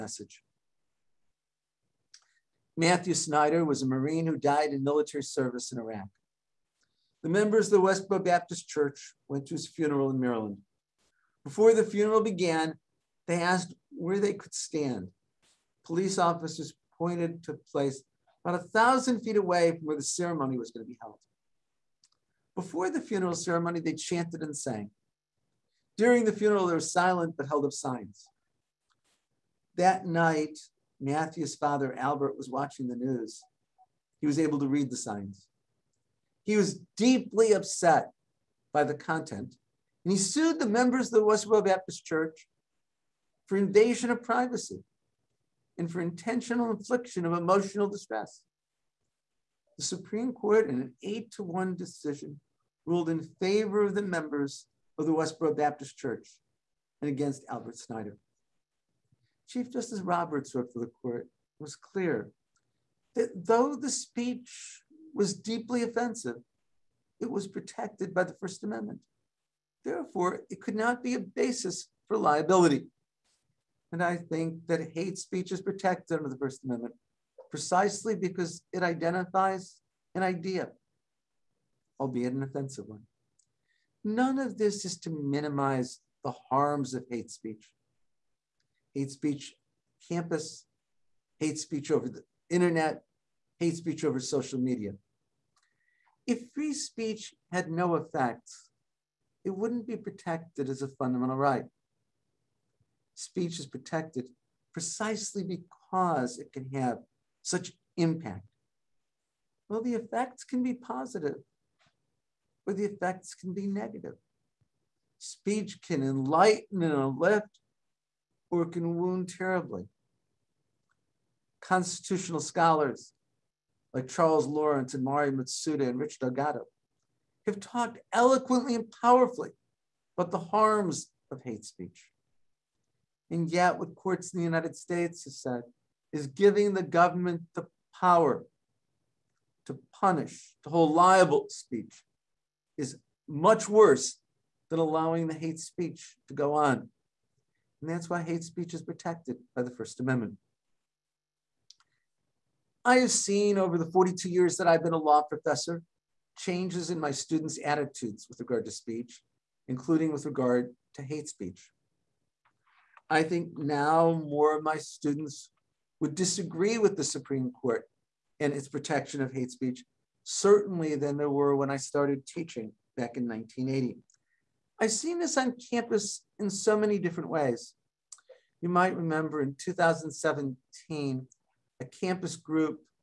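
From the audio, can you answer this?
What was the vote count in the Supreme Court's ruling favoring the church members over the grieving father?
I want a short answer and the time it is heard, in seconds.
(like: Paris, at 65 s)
8 to 1, at 51 s.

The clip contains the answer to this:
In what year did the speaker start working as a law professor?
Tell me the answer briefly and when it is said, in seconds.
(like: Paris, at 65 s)
1980, at 173 s.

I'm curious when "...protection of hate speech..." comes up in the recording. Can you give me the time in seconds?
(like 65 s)
168 s.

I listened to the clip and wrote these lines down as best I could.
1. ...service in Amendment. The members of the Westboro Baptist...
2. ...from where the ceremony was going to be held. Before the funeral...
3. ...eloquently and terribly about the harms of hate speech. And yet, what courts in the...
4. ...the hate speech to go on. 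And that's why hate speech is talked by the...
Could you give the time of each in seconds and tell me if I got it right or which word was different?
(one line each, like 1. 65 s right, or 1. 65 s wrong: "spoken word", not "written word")
1. 5 s wrong: "Iraq", not "Amendment"
2. 19 s right
3. 128 s wrong: "powerfully", not "terribly"
4. 145 s wrong: "protected", not "talked".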